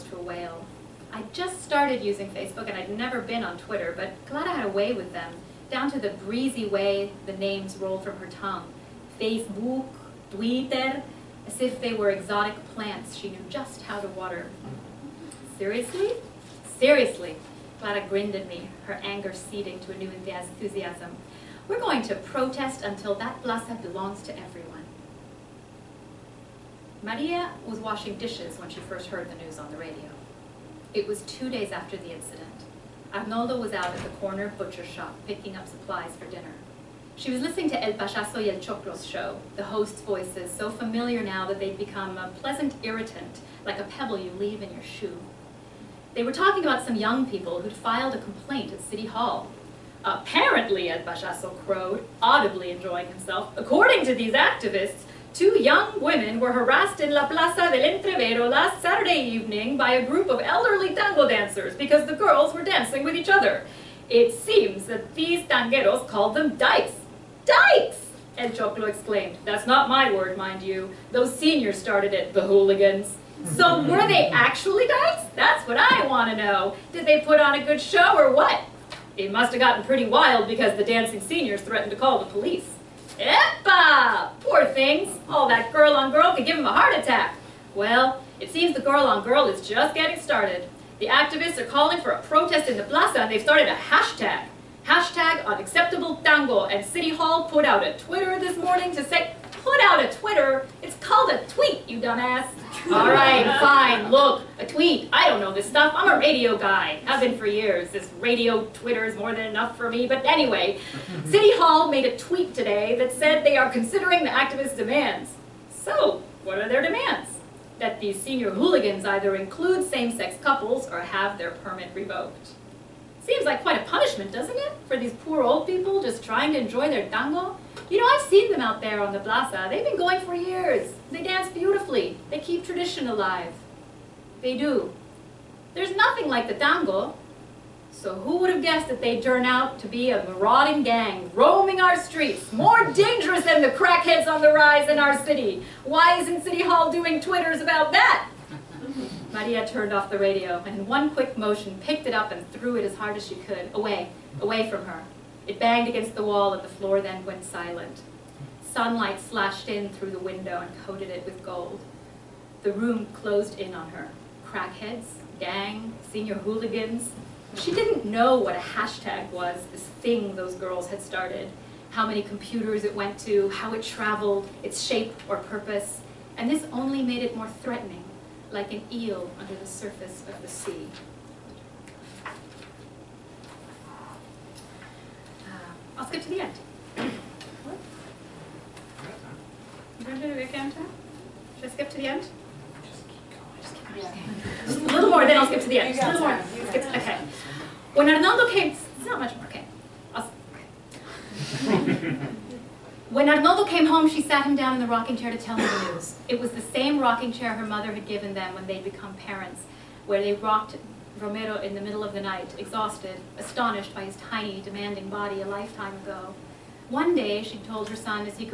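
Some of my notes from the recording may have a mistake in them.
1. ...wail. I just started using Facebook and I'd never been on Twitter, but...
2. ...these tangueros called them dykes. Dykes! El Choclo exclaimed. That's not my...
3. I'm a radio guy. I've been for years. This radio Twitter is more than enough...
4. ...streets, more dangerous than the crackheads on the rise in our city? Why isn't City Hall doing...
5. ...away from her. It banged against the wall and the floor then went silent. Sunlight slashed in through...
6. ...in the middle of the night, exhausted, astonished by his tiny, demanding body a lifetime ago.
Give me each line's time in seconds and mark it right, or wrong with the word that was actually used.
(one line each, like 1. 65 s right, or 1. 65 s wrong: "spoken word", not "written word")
1. 0 s right
2. 65 s right
3. 105 s right
4. 141 s right
5. 154 s right
6. 211 s right.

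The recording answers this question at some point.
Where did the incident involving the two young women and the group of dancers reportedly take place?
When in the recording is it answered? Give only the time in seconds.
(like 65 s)
57 s.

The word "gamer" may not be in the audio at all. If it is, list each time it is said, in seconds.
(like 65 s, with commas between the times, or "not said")
not said.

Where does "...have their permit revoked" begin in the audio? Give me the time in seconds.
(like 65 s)
120 s.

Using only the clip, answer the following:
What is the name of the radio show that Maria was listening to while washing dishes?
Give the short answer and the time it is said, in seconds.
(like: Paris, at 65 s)
El Pachazo y el Choclo, at 37 s.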